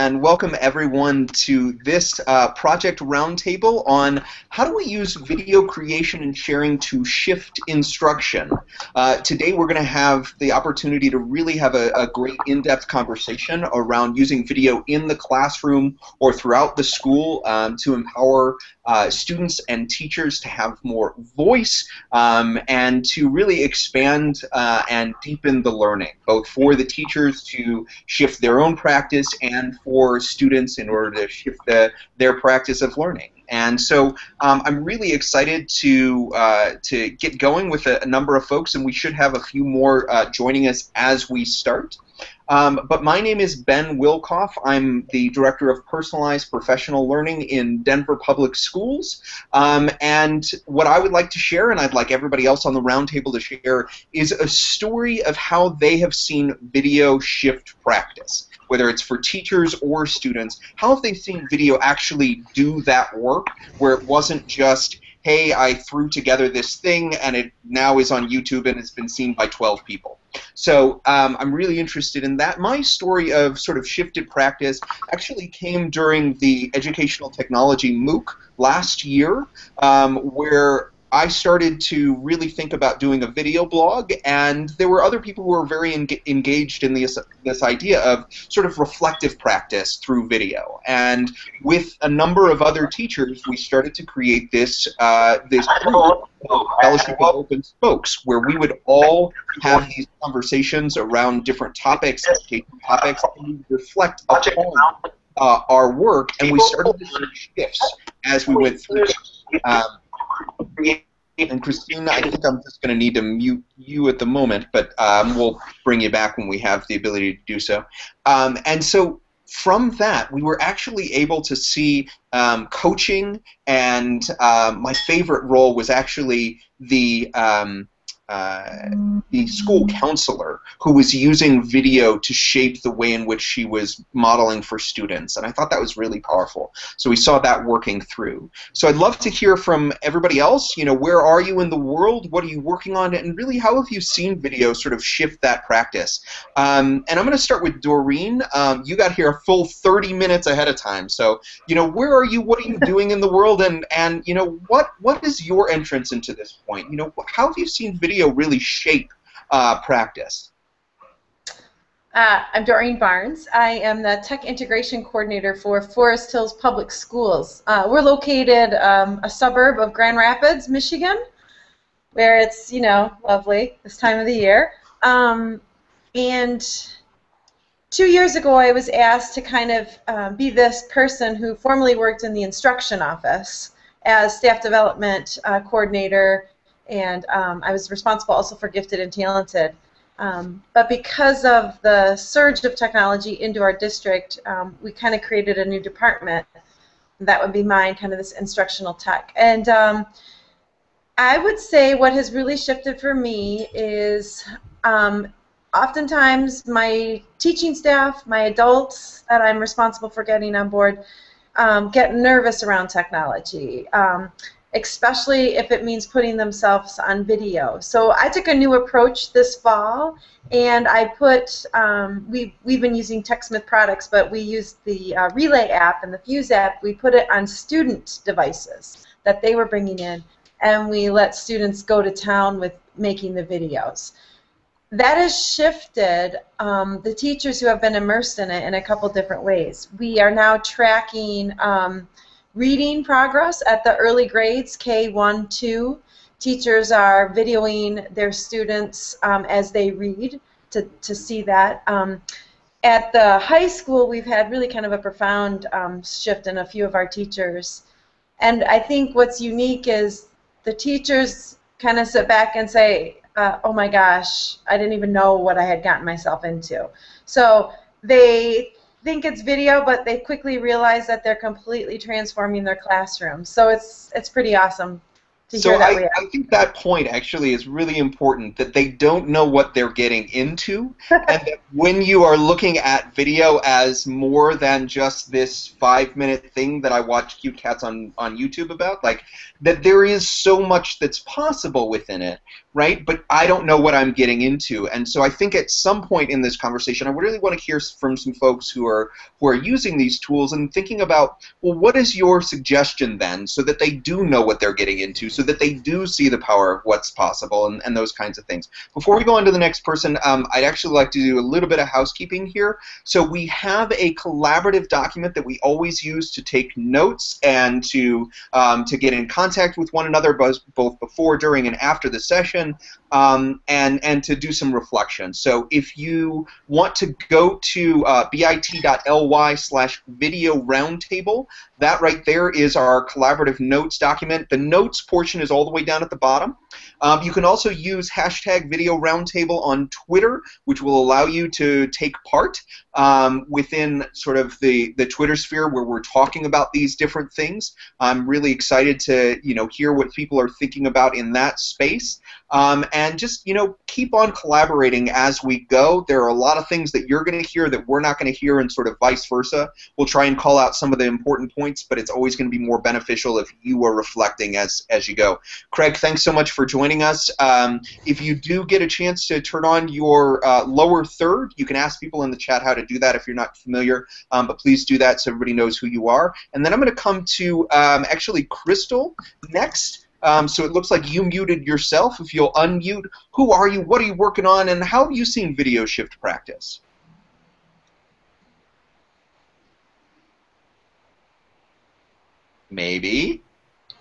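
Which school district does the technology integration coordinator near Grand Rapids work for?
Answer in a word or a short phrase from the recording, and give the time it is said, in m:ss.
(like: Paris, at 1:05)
Forest Hills Public Schools, at 2:45.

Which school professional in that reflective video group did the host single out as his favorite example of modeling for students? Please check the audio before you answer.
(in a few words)
school counselor.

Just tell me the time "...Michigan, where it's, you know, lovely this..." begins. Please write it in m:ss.
2:50.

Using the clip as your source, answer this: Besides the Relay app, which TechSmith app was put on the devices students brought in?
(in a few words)
Fuse.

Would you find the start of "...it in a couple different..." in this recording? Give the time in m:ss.
3:58.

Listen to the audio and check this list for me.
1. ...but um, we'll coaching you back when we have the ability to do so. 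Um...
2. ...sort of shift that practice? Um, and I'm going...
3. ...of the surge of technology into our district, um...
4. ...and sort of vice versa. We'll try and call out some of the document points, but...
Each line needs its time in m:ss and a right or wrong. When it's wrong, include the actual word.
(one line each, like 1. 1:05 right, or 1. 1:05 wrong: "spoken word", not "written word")
1. 1:54 wrong: "bring", not "coaching"
2. 2:24 right
3. 3:11 right
4. 5:58 wrong: "important", not "document".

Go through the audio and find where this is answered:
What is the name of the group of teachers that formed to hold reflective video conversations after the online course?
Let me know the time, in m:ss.
1:36.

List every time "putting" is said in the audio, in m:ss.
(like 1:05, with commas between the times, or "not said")
3:36.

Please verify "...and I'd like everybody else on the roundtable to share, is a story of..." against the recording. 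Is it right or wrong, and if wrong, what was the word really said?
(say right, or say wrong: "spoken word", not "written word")
right.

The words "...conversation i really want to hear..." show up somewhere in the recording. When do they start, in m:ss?
4:56.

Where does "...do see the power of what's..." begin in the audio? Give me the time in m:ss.
5:05.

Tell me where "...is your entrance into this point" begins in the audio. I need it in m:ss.
2:35.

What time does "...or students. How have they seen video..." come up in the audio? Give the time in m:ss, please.
0:59.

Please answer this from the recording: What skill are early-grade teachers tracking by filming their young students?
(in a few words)
reading progress.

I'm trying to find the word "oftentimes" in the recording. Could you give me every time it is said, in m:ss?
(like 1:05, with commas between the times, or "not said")
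3:25.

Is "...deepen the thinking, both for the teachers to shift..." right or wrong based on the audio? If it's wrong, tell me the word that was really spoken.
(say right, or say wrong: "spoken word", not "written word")
wrong: "learning", not "thinking".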